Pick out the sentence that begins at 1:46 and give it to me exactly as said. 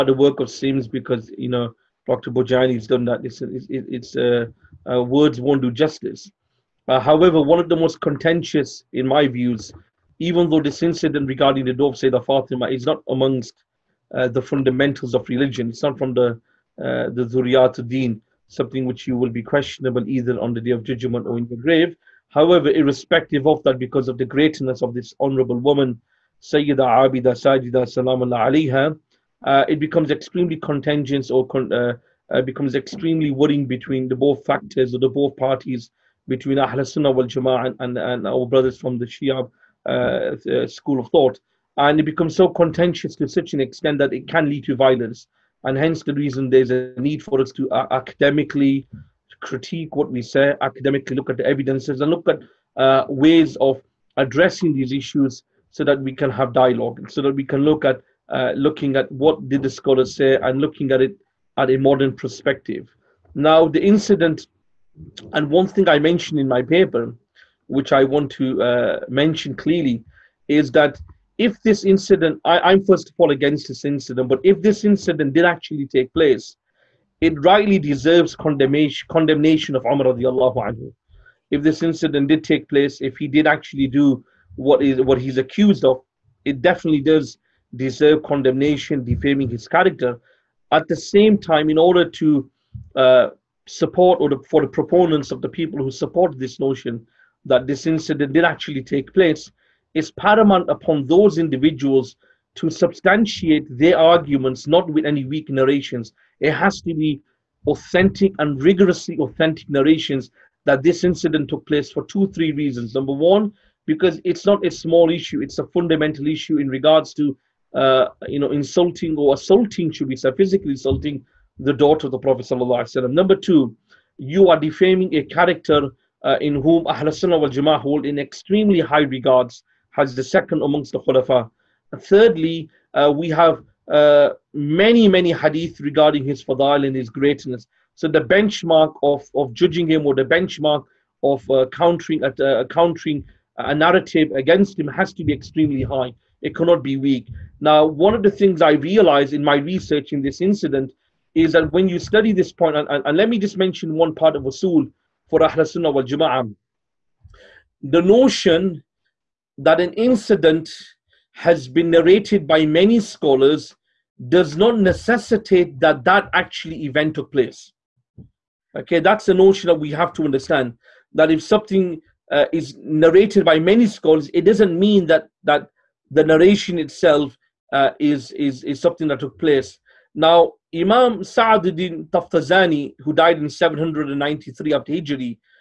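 It has to be authentic and rigorously authentic narrations that this incident took place for two, three reasons.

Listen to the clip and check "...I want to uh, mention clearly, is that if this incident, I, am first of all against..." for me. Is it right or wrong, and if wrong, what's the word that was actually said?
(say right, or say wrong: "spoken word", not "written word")
right.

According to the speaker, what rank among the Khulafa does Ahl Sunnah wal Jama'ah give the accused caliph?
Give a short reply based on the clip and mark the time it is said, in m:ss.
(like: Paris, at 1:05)
Second, at 2:10.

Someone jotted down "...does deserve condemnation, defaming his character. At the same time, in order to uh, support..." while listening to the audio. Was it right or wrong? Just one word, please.
right.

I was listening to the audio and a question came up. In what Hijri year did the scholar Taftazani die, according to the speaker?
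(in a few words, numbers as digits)
793.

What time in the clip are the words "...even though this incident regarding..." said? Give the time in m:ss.
0:10.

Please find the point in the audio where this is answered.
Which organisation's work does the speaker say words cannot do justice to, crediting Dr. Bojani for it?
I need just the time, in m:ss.
0:00.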